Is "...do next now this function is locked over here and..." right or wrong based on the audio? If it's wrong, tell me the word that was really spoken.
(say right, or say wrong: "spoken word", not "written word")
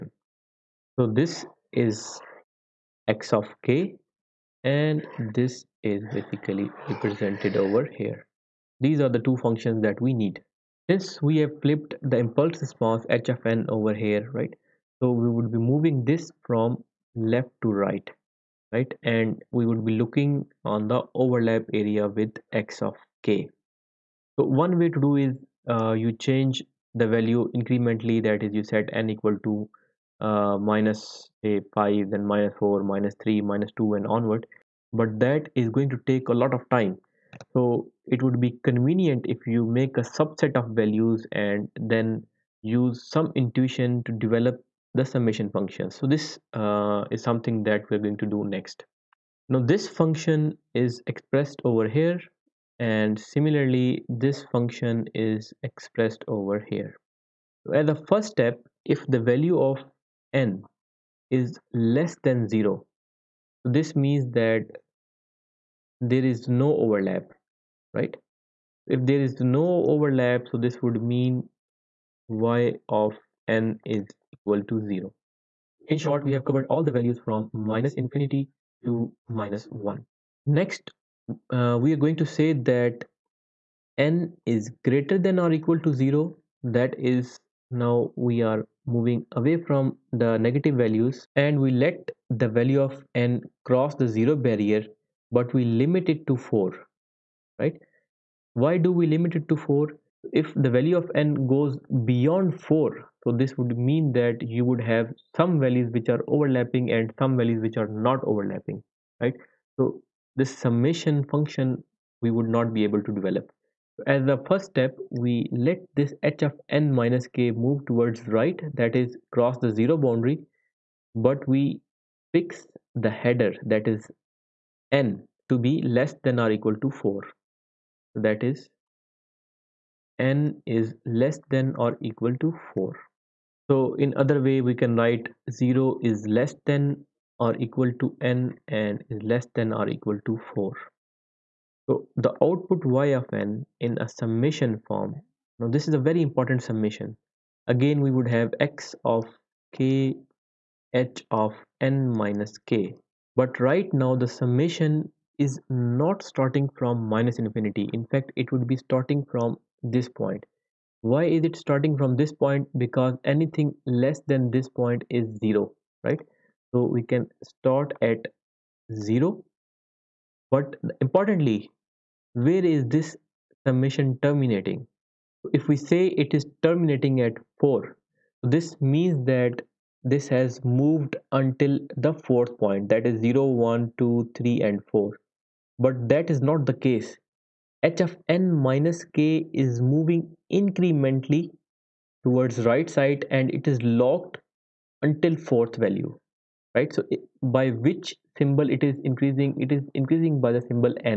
wrong: "expressed", not "locked".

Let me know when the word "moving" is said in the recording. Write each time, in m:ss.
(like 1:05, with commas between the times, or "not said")
0:15, 1:28, 3:09.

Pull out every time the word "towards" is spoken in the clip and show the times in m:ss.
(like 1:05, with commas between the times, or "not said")
1:57, 3:12.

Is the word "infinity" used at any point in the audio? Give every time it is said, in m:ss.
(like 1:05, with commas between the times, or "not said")
1:17, 2:37.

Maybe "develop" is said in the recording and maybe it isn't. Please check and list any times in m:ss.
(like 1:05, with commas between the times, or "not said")
0:44, 1:53.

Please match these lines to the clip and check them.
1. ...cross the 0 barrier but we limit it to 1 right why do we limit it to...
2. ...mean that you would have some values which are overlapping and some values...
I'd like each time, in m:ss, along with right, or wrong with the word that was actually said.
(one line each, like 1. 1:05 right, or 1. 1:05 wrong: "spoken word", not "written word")
1. 1:33 wrong: "4", not "1"
2. 1:43 right.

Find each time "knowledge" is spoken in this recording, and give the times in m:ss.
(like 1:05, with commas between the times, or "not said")
not said.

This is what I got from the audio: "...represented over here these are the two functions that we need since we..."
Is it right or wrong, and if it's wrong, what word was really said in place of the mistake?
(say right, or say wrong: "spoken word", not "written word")
right.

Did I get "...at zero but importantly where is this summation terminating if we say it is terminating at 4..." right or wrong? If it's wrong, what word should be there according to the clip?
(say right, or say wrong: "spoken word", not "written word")
right.